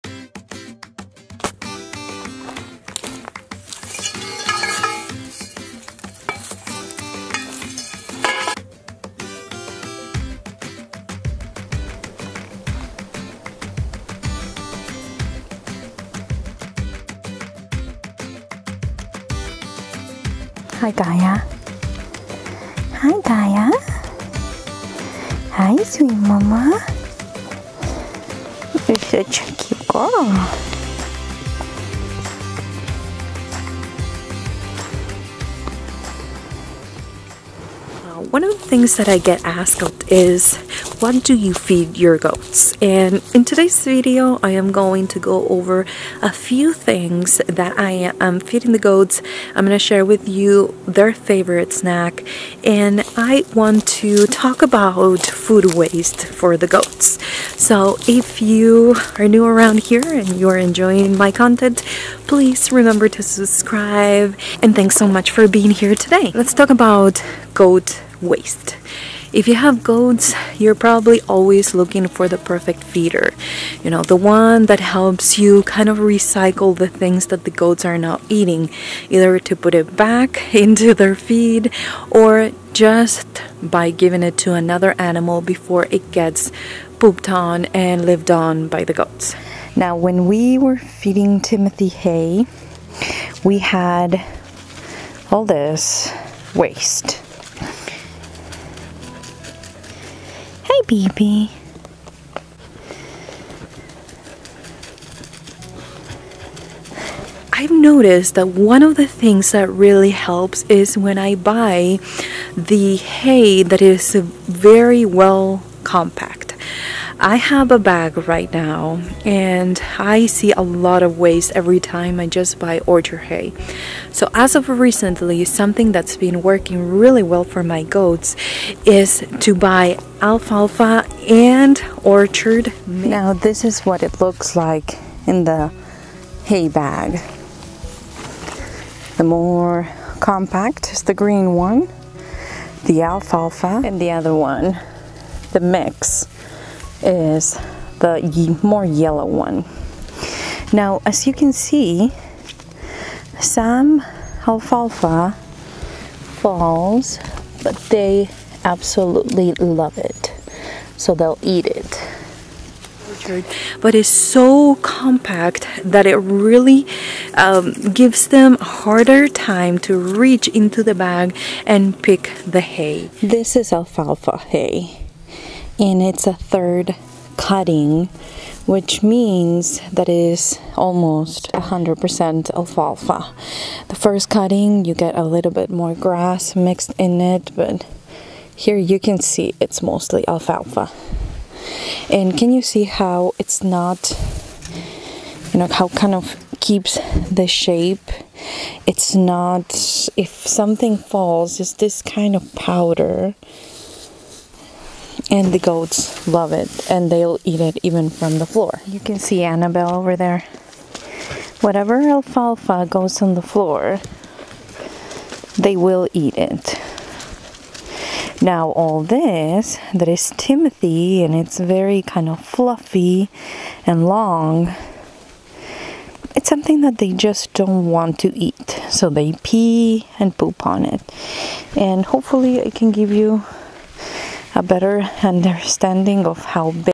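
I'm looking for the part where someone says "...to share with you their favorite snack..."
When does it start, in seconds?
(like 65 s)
49 s.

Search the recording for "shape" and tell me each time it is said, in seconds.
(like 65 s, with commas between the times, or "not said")
197 s.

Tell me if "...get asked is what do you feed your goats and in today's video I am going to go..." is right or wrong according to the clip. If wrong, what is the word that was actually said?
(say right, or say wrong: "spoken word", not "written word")
right.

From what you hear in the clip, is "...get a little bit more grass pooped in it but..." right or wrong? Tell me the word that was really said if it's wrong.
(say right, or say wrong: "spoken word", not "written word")
wrong: "mixed", not "pooped".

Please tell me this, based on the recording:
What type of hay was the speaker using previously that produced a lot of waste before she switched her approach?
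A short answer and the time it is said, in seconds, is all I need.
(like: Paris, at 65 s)
Timothy hay, at 91 s.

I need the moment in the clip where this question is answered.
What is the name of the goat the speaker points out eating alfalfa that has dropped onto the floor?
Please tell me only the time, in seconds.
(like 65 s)
209 s.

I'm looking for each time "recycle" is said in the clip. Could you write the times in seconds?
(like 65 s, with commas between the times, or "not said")
75 s.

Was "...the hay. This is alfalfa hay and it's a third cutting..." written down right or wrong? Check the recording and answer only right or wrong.
right.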